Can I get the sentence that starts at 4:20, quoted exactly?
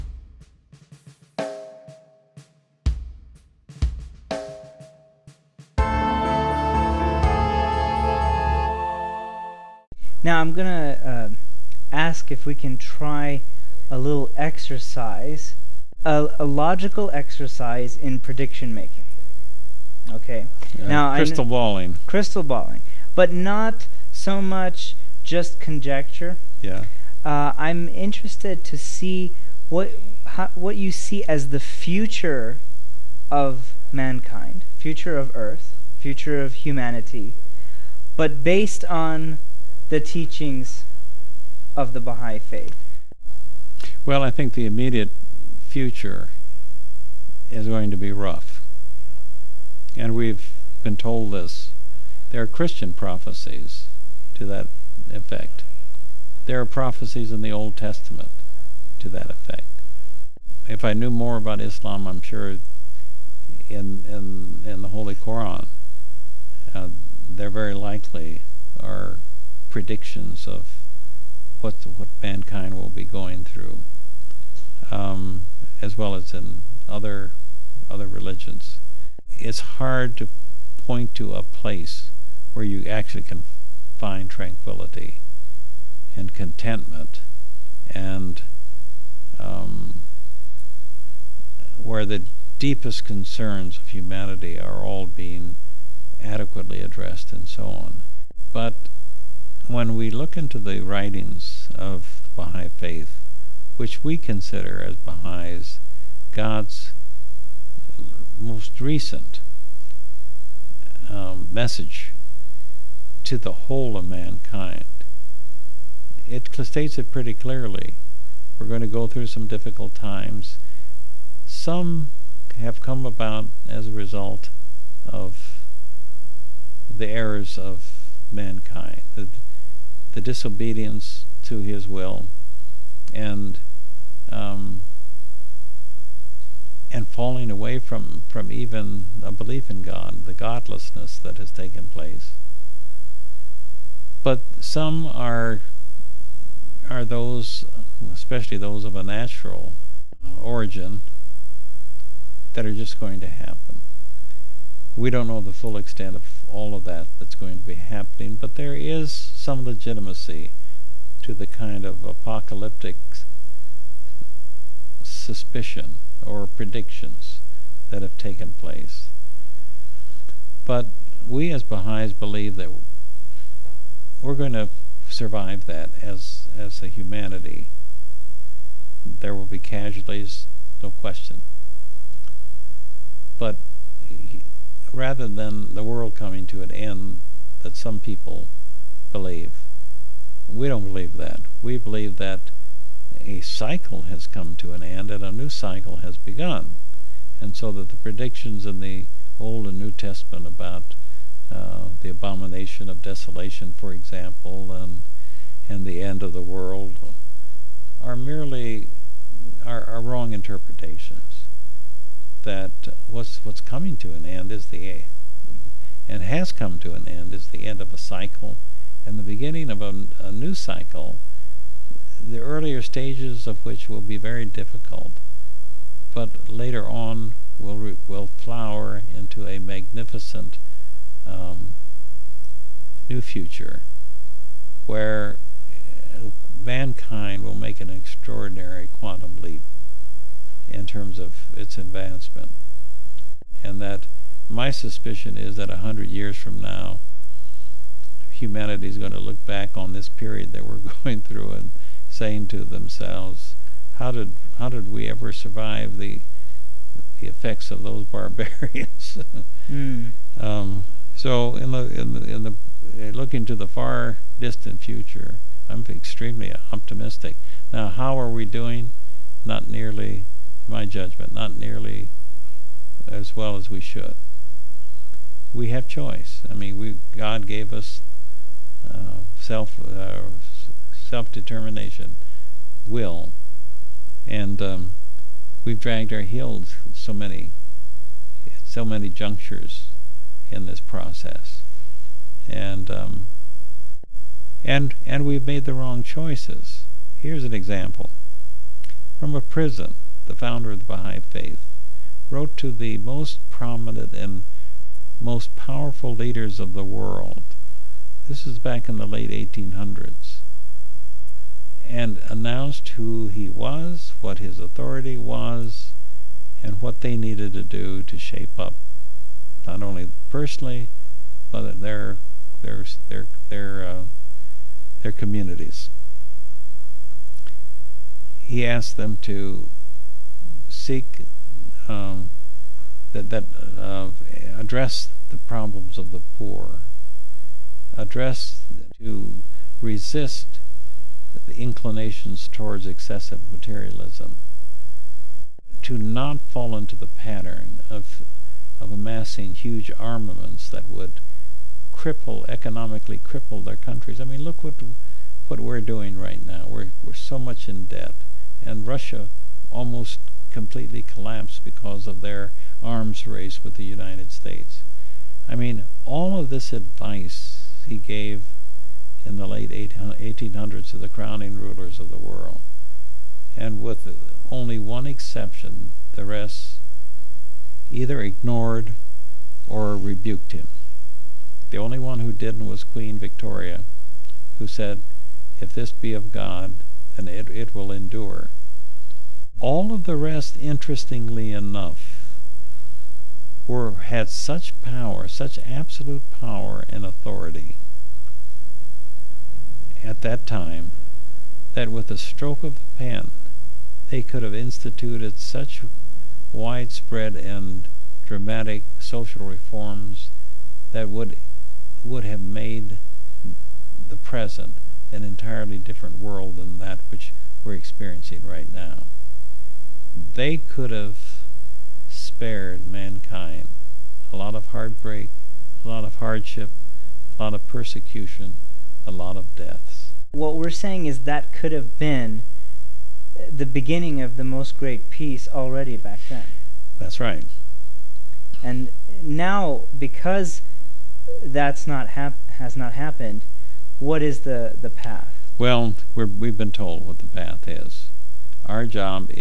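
um, so, in the in the, in the eh, looking to the far distant future, I'm extremely optimistic.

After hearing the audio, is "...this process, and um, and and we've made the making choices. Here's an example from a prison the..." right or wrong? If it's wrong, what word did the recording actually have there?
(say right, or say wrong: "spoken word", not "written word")
wrong: "wrong", not "making".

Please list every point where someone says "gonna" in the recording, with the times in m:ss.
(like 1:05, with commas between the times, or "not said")
0:10.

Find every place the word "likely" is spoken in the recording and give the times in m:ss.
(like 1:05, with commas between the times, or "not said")
1:07.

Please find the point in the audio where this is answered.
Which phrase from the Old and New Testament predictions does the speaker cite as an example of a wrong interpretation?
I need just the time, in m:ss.
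3:22.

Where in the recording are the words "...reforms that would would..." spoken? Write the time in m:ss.
6:49.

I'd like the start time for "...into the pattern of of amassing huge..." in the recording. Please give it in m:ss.
5:46.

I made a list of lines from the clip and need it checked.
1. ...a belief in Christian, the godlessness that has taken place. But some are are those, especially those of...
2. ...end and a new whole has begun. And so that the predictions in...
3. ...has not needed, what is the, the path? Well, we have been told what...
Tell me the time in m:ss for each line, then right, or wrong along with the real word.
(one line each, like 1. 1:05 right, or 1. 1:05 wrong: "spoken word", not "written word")
1. 2:19 wrong: "God", not "Christian"
2. 3:14 wrong: "cycle", not "whole"
3. 7:22 wrong: "happened", not "needed".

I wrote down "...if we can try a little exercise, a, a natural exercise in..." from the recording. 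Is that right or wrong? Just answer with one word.
wrong.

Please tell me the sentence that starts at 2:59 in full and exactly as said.
There will be casualties, no question.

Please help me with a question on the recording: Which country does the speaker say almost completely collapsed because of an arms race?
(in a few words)
Russia.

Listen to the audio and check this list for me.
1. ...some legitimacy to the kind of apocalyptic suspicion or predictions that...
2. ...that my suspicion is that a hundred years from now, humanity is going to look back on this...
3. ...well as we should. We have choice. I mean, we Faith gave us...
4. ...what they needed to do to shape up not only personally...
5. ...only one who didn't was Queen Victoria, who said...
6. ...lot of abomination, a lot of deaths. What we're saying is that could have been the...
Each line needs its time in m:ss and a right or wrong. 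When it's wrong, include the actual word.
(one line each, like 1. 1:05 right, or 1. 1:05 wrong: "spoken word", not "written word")
1. 2:39 right
2. 4:03 right
3. 4:33 wrong: "God", not "Faith"
4. 5:16 right
5. 6:21 right
6. 7:07 wrong: "persecution", not "abomination".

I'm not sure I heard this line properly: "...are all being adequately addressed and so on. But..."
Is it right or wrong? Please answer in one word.
right.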